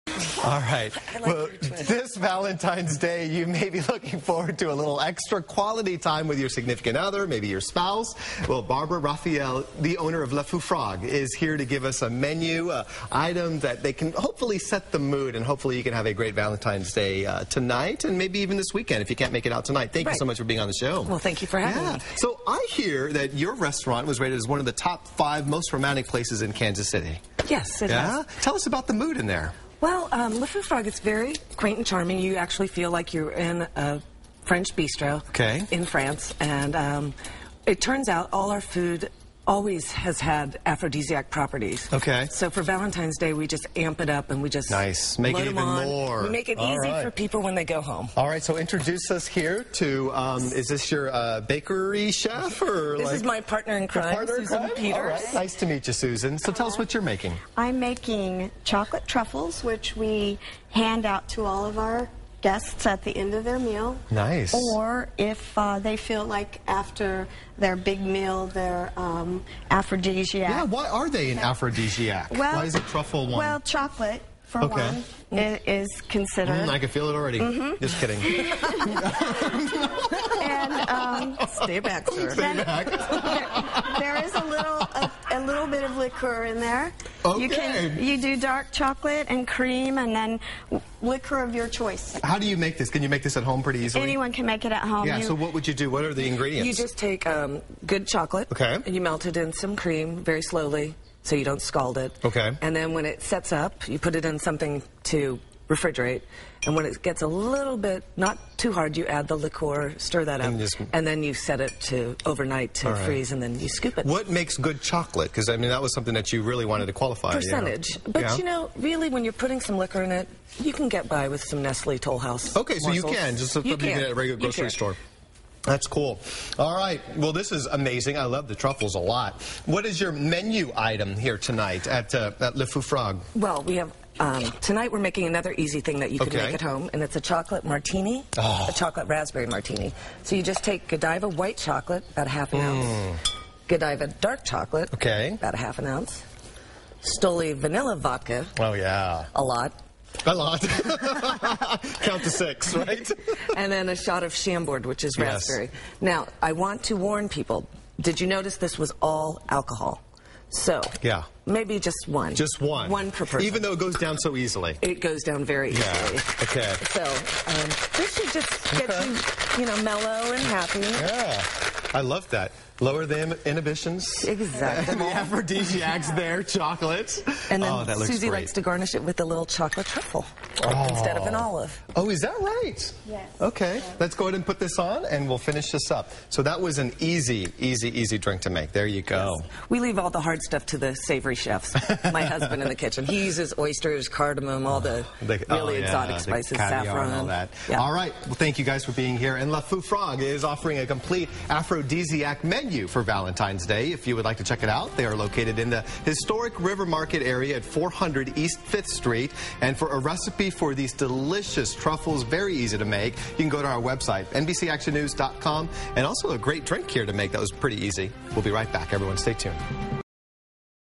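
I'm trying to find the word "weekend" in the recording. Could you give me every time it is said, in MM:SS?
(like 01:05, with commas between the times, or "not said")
00:18.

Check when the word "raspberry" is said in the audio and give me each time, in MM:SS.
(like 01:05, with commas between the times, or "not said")
02:19, 02:35.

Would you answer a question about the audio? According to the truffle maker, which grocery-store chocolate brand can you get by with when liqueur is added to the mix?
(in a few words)
Nestle Toll House.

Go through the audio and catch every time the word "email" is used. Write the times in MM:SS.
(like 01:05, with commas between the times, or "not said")
not said.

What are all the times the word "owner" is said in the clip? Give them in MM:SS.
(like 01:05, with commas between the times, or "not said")
00:09.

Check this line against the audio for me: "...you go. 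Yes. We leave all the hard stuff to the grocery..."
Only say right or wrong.
wrong.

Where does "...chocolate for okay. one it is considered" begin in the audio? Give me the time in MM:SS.
01:13.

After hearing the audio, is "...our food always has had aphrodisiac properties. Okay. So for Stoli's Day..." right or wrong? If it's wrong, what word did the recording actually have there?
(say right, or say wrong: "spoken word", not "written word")
wrong: "Valentine", not "Stoli".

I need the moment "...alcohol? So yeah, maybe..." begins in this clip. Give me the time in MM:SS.
02:39.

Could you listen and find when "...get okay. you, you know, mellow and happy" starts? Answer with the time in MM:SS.
02:48.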